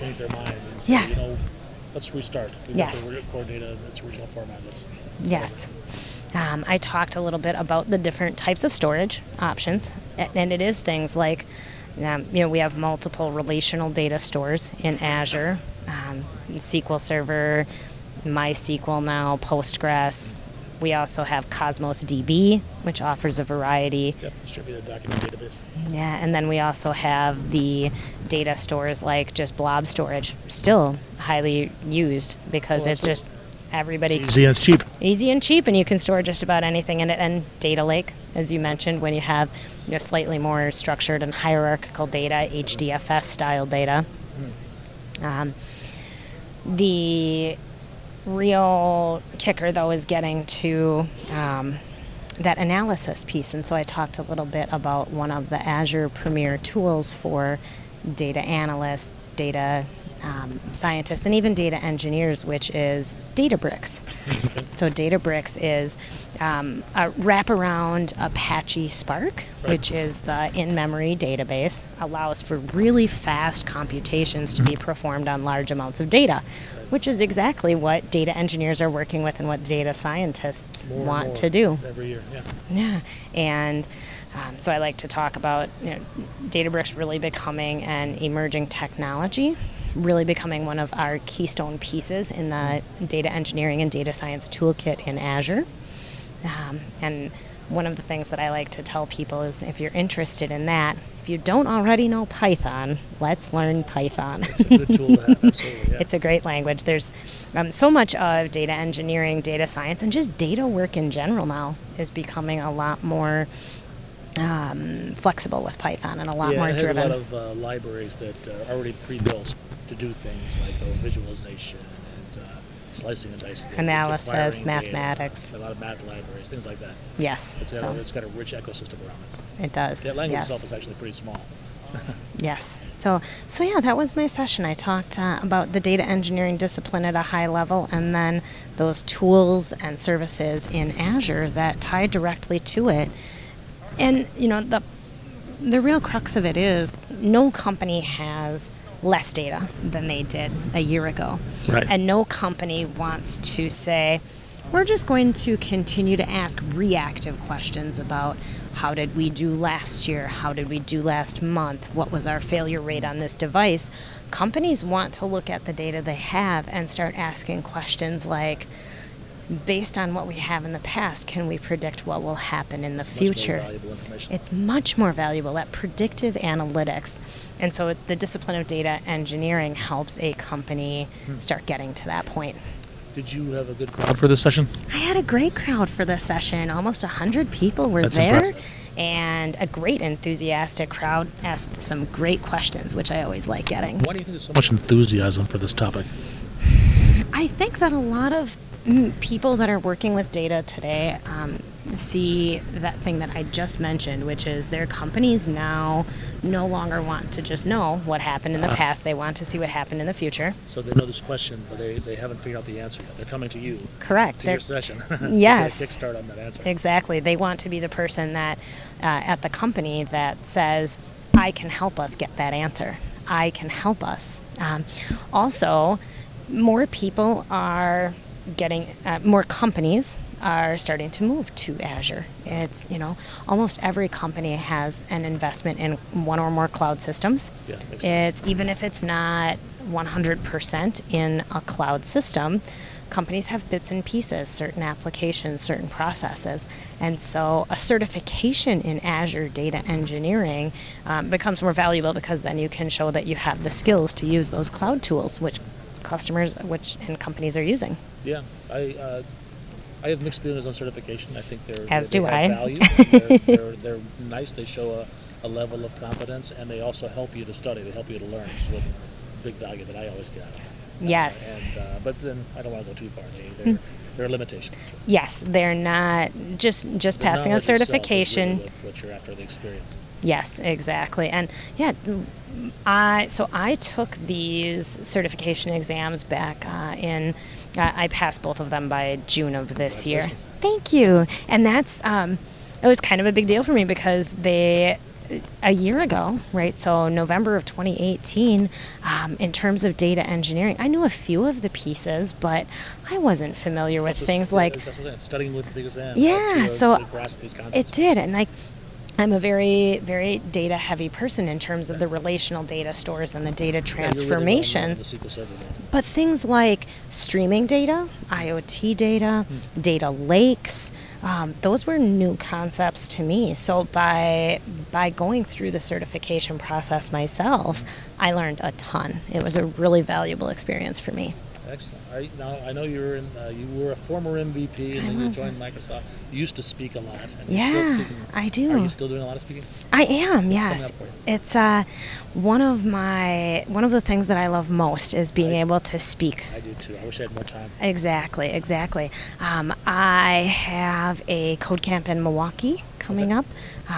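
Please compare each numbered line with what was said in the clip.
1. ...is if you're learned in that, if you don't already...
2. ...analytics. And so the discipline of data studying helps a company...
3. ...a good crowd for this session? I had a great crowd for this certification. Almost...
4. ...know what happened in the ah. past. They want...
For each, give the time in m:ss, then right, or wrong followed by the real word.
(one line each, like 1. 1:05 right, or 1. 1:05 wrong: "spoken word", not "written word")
1. 1:39 wrong: "interested", not "learned"
2. 2:56 wrong: "engineering", not "studying"
3. 3:03 wrong: "session", not "certification"
4. 3:27 right.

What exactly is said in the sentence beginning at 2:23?
And you know, the the real crux of it is no company has less data than they did a year ago.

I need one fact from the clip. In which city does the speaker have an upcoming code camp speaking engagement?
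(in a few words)
Milwaukee.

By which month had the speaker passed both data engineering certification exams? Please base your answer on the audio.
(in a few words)
June.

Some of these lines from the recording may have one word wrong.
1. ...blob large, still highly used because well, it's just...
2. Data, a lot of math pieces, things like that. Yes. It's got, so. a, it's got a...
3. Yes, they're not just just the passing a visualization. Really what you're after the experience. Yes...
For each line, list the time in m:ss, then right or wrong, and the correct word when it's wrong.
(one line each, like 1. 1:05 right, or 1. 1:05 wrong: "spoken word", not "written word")
1. 0:29 wrong: "storage", not "large"
2. 2:05 wrong: "libraries", not "pieces"
3. 4:35 wrong: "certification", not "visualization".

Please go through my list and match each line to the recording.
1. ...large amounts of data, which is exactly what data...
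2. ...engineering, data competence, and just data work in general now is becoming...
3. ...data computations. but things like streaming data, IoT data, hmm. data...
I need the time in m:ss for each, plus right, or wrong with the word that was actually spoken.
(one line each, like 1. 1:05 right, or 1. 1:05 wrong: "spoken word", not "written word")
1. 1:15 right
2. 1:48 wrong: "science", not "competence"
3. 5:13 wrong: "transformations", not "computations".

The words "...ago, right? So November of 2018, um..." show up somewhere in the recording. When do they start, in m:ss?
4:55.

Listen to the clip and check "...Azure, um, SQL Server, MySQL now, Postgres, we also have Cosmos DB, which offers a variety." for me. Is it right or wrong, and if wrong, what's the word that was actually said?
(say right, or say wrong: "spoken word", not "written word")
right.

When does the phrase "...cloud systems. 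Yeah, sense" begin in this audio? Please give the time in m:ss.
3:56.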